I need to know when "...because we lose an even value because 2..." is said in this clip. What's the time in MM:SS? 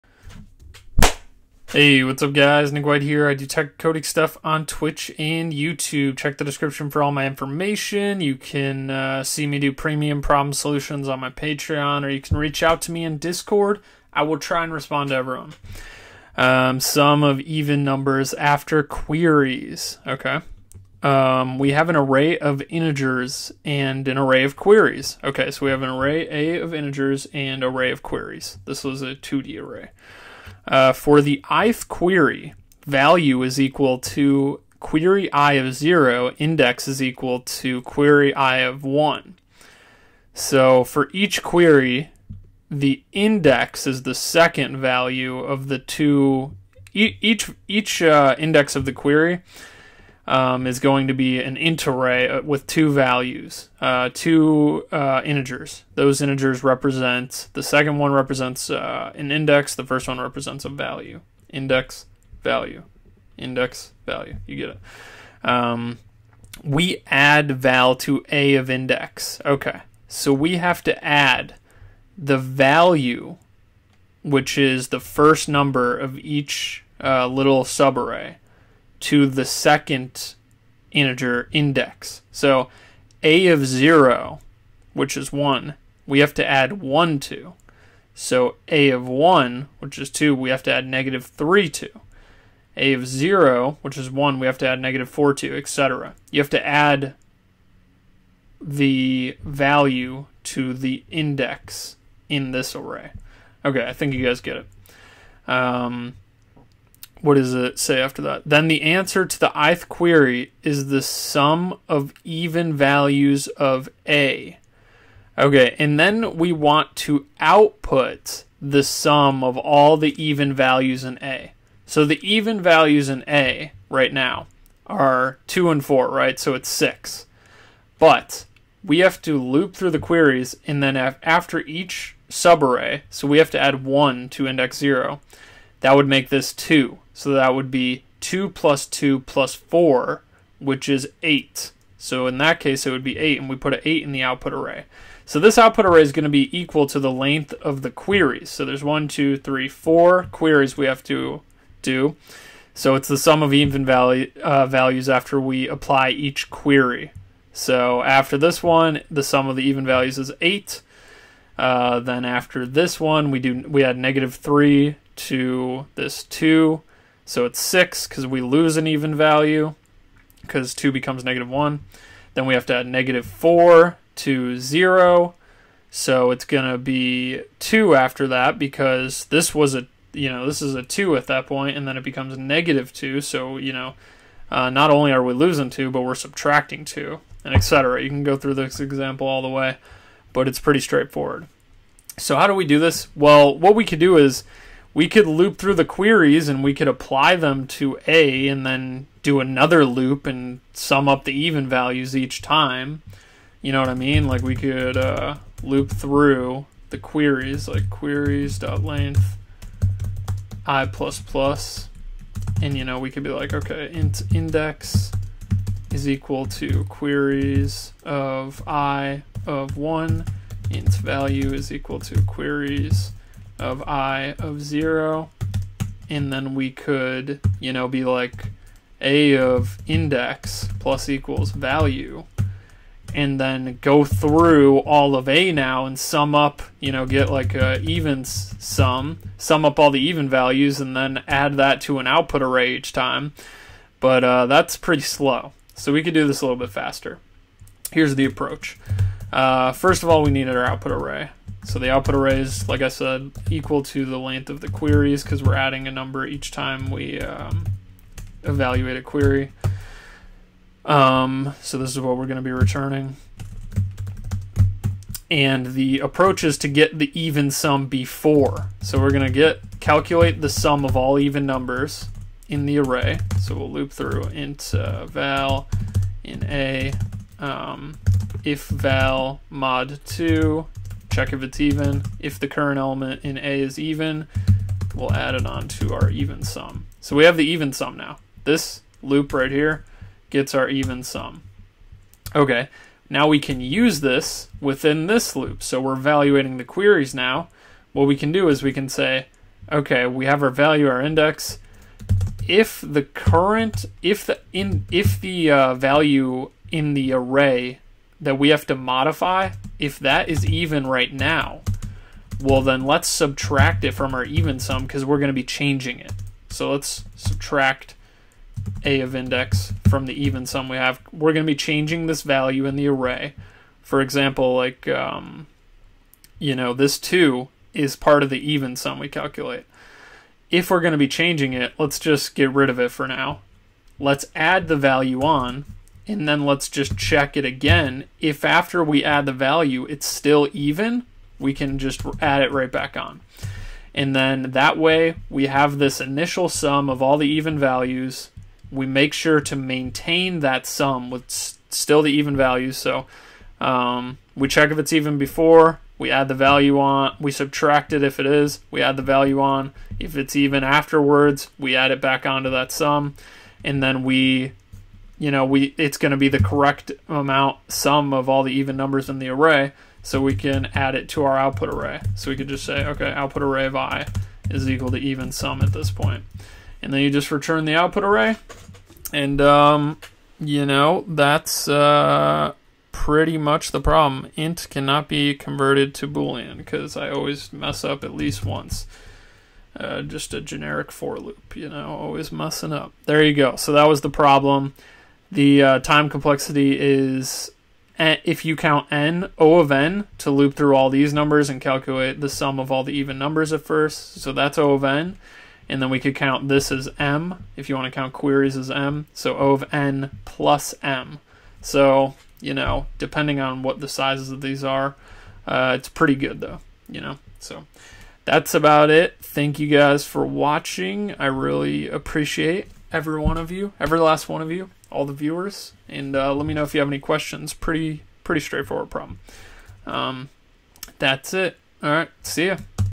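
02:48.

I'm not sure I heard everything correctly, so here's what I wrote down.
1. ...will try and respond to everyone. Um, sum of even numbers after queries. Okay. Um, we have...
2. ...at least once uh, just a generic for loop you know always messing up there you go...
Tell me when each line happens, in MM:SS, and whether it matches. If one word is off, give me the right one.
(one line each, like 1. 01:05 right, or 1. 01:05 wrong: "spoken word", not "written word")
1. 00:14 right
2. 06:28 right.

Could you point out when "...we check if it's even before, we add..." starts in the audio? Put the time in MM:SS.
05:54.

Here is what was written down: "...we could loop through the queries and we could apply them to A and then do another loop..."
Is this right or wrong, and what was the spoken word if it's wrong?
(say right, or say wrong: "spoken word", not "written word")
right.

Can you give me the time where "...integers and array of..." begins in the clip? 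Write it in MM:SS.
00:26.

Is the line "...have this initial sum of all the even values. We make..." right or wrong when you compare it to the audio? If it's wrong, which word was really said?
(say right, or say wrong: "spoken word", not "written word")
right.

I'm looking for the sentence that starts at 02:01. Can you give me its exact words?
So the even values in A right now are 2 and 4, right?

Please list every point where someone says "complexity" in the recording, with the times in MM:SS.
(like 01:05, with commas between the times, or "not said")
06:36.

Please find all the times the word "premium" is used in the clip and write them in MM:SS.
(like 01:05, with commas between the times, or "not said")
00:09.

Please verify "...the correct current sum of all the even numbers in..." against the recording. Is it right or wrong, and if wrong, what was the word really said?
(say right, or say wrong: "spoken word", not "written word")
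wrong: "amount", not "current".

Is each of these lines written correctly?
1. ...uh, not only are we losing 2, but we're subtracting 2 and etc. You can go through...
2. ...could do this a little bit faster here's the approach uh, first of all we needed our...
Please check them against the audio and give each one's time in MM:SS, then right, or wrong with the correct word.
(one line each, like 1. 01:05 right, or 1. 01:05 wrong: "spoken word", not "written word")
1. 03:04 right
2. 04:06 right.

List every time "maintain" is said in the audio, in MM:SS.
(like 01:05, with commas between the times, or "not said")
05:49.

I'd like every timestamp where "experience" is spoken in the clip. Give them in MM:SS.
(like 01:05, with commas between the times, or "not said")
not said.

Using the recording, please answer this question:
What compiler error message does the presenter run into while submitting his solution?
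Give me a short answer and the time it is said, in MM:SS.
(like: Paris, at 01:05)
int cannot be converted to boolean, at 06:24.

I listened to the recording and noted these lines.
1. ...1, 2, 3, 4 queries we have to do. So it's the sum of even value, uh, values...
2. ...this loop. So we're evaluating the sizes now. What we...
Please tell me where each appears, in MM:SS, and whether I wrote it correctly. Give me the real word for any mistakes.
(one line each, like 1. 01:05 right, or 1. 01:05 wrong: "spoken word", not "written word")
1. 02:28 right
2. 04:55 wrong: "queries", not "sizes".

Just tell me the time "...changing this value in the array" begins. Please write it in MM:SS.
05:21.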